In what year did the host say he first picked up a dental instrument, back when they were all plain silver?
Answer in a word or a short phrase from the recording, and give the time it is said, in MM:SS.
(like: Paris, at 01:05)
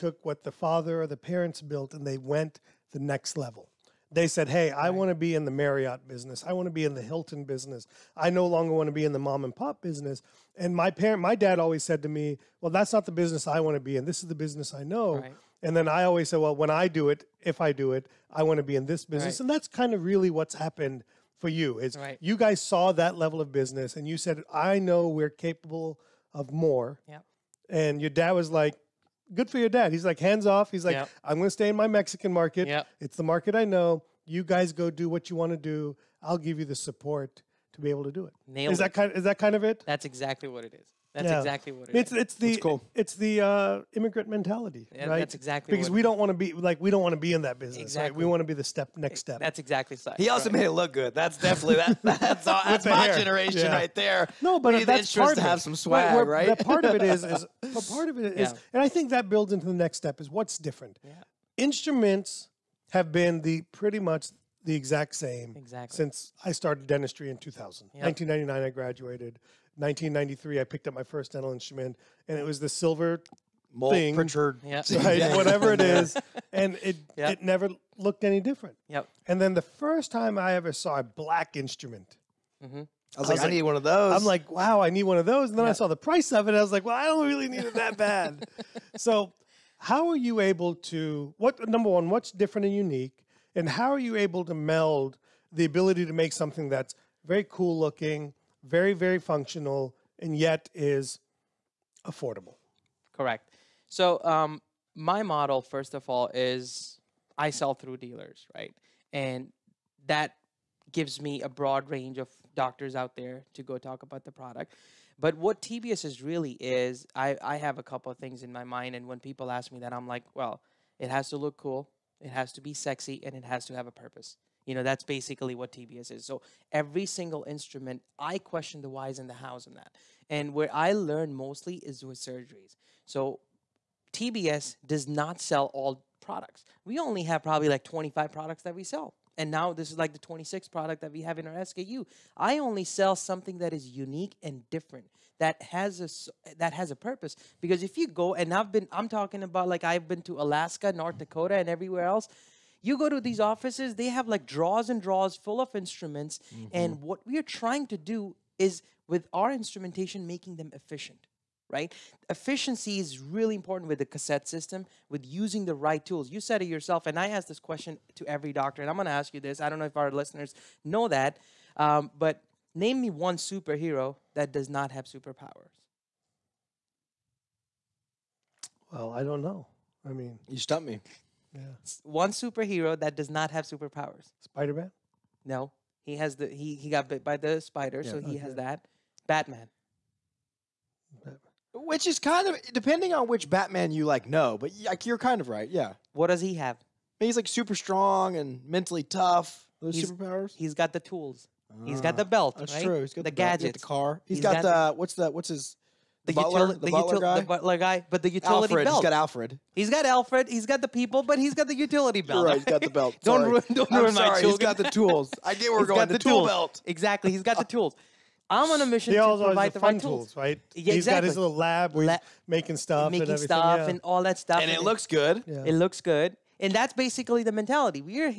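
1993, at 01:09.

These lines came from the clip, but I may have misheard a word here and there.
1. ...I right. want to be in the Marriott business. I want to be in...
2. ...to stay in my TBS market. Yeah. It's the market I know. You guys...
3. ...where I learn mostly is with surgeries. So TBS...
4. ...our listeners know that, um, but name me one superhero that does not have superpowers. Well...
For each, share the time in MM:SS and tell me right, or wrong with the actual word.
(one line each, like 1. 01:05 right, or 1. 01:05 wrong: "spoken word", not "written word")
1. 00:04 right
2. 00:31 wrong: "Mexican", not "TBS"
3. 02:10 right
4. 02:49 right.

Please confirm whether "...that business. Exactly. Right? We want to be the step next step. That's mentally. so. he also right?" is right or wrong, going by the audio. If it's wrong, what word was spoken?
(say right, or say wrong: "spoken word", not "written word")
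wrong: "exactly", not "mentally".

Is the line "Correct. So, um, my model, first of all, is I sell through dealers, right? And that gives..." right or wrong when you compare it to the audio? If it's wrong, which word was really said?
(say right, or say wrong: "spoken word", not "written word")
right.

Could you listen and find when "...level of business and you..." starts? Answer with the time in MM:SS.
00:23.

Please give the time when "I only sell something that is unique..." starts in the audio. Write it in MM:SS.
02:22.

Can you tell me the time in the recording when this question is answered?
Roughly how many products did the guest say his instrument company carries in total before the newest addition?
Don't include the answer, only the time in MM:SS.
02:17.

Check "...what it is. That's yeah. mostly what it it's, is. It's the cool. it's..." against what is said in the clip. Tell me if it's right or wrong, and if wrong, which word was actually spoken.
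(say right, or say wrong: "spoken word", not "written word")
wrong: "exactly", not "mostly".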